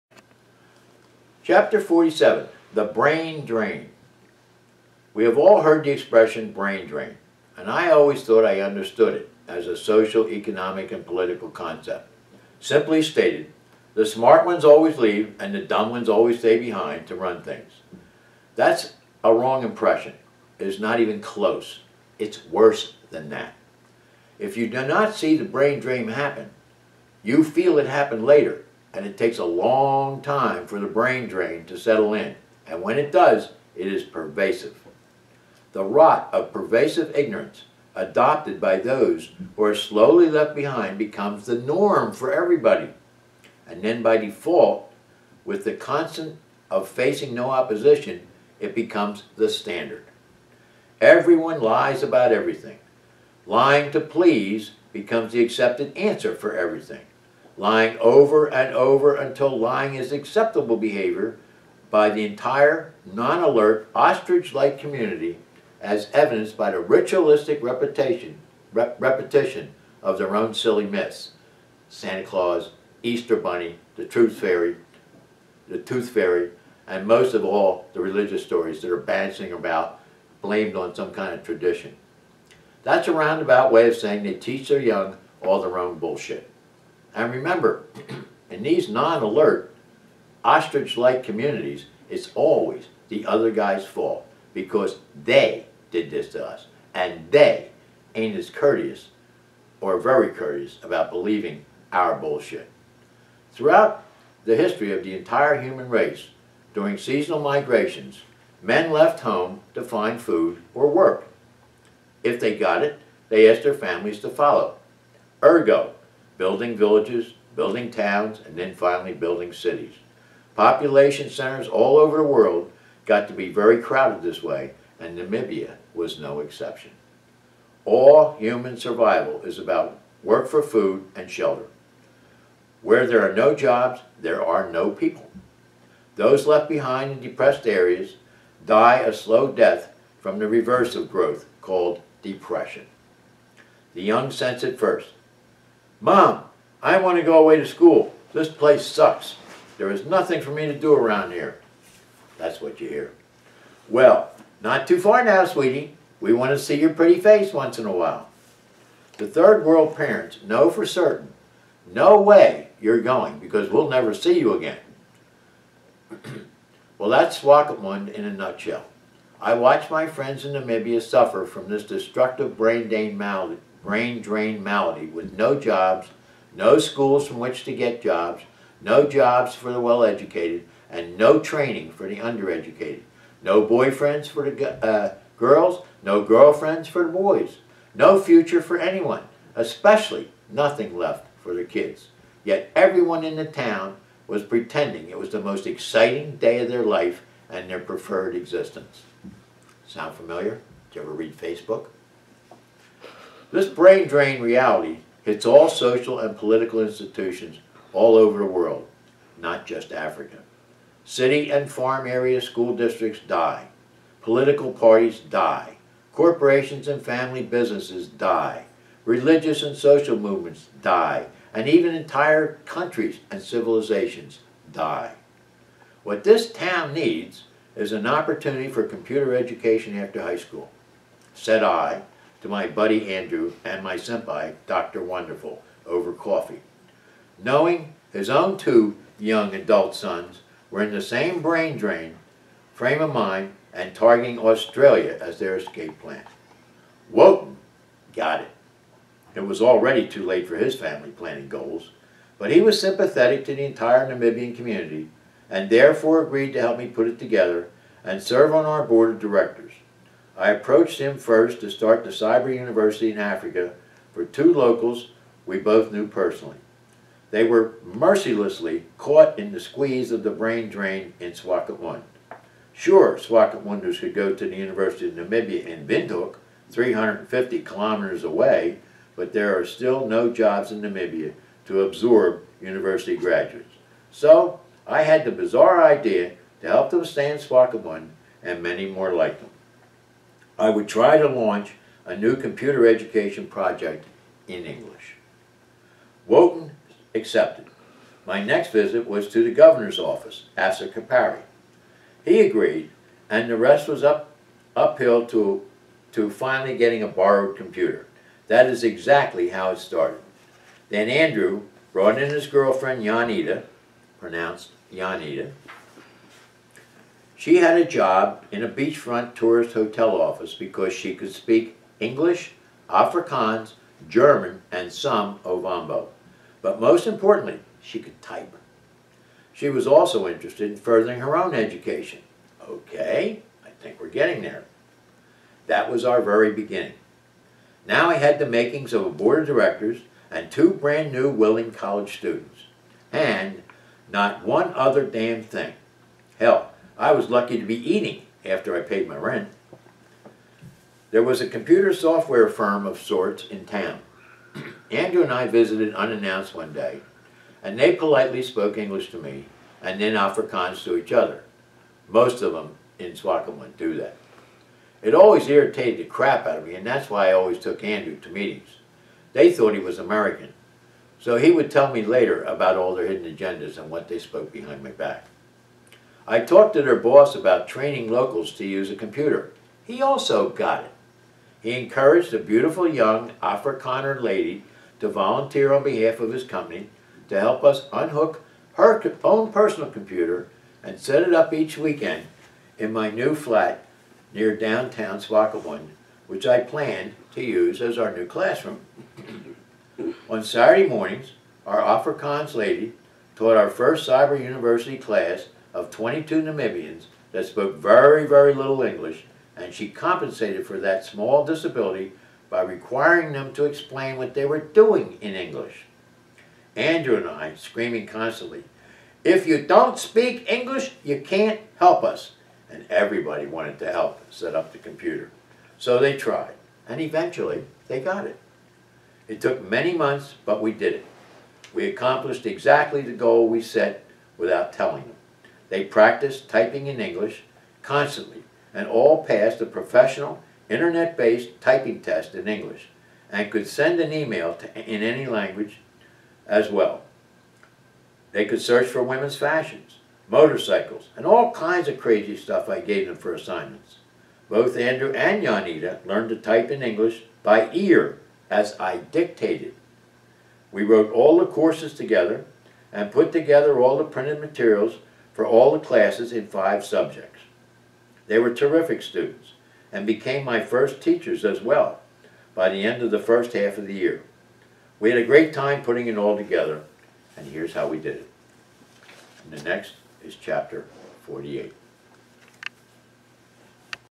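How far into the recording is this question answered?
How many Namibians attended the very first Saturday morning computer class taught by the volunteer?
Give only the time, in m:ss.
6:45.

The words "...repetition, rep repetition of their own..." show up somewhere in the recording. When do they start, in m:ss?
1:07.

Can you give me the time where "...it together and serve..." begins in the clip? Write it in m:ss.
4:17.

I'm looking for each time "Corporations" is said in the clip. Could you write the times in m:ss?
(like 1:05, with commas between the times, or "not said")
3:36.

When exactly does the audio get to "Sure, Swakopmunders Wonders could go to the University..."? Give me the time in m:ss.
4:32.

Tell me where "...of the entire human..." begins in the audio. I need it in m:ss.
1:44.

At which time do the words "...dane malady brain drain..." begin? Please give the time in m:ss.
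2:52.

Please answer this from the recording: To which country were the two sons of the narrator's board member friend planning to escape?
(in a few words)
Australia.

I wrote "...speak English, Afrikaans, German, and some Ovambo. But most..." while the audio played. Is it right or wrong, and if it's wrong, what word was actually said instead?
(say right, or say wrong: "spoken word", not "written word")
right.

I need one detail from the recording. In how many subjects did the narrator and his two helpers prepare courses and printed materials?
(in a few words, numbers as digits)
5.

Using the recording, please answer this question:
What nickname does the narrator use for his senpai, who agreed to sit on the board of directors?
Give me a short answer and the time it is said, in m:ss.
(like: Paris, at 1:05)
Dr. Wonderful, at 3:54.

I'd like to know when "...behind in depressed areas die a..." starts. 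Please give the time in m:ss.
2:16.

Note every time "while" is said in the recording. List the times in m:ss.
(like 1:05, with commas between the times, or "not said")
2:37.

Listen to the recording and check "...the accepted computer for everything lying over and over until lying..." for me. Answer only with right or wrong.
wrong.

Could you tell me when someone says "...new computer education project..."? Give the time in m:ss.
4:52.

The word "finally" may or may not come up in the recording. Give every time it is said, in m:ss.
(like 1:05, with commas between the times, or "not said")
1:58, 5:06.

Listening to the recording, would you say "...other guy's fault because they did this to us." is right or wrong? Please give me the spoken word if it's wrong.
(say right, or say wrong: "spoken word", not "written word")
right.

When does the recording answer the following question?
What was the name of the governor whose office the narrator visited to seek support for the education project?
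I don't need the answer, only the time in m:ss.
5:00.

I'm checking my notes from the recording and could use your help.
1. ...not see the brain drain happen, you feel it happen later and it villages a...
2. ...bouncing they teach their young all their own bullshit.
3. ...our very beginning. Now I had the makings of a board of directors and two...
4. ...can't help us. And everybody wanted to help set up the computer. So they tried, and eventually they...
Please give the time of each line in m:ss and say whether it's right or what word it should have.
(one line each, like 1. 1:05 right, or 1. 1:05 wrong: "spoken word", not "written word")
1. 0:24 wrong: "takes", not "villages"
2. 1:23 wrong: "saying", not "bouncing"
3. 5:36 right
4. 7:01 right.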